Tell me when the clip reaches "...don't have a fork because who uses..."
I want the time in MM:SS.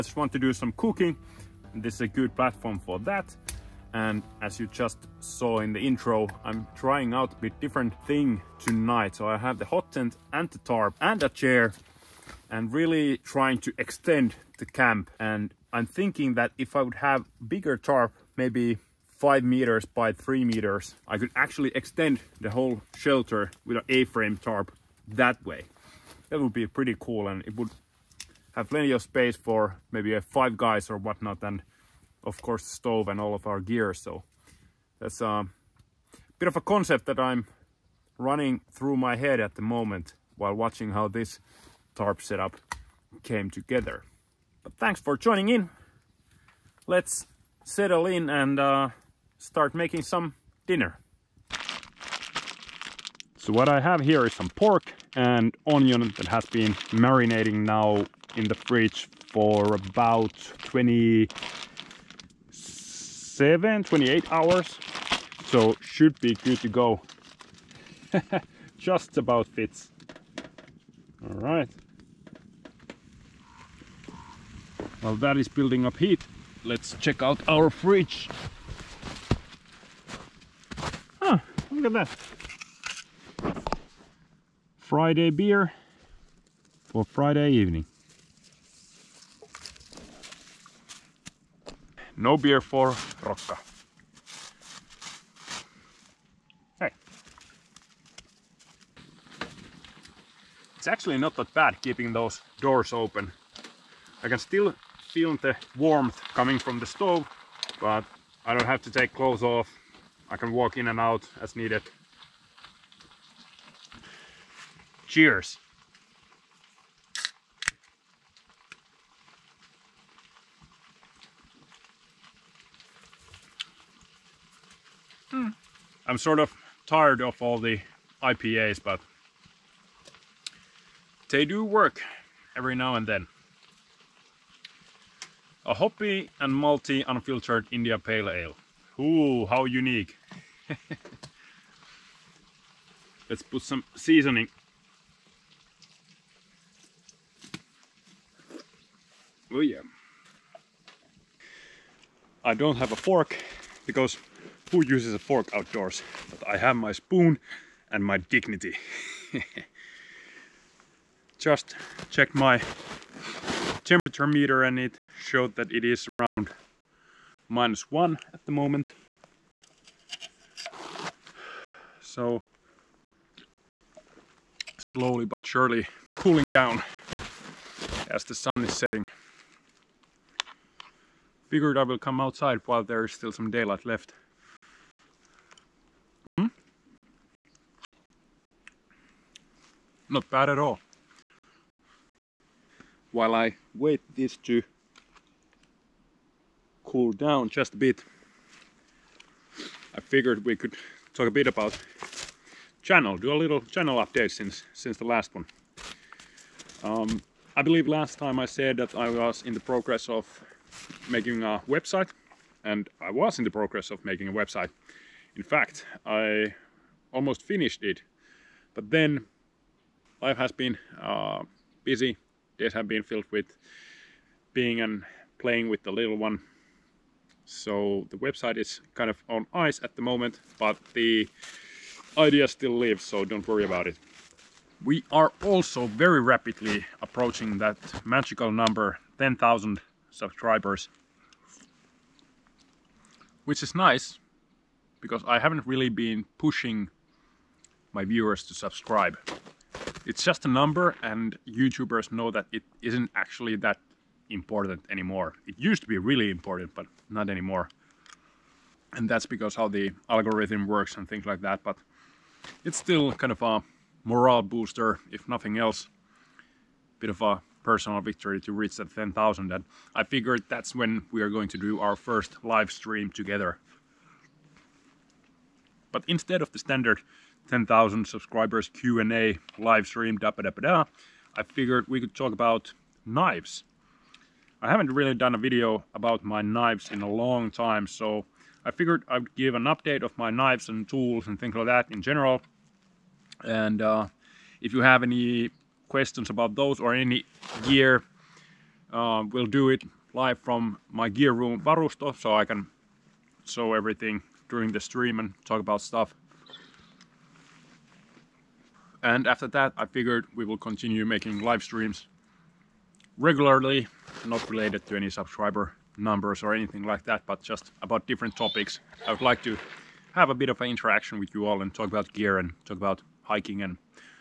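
02:32.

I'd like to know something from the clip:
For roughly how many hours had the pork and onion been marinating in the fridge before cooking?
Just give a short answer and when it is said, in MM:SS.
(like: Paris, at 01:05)
27-28 hours, at 01:00.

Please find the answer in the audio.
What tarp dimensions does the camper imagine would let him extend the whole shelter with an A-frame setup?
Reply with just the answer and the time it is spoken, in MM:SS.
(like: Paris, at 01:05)
5 meters by 3 meters, at 00:19.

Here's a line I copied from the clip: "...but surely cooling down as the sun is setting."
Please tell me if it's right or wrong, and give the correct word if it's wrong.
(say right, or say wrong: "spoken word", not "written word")
right.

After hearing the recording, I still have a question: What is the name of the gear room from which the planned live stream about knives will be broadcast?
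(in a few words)
Varusto.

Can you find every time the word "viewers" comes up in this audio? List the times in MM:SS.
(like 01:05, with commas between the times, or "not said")
04:08.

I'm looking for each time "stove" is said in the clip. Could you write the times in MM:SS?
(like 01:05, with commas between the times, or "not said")
00:32, 01:46.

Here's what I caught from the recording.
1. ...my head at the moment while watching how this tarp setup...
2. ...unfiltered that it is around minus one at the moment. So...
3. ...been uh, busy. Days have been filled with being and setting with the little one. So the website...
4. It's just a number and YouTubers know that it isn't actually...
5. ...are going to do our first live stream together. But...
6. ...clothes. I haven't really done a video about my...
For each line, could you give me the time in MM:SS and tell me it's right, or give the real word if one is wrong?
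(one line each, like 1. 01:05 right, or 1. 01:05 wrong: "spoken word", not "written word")
1. 00:38 right
2. 02:45 wrong: "showed", not "unfiltered"
3. 03:40 wrong: "playing", not "setting"
4. 04:10 right
5. 04:31 right
6. 04:43 wrong: "knives", not "clothes".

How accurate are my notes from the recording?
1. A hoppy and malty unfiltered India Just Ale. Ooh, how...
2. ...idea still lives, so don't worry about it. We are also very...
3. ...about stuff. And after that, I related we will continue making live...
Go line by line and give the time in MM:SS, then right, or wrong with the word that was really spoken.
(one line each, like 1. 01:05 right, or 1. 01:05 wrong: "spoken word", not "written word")
1. 02:15 wrong: "Pale", not "Just"
2. 03:52 right
3. 05:05 wrong: "figured", not "related".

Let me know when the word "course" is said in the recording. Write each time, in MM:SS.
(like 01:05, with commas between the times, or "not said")
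00:32.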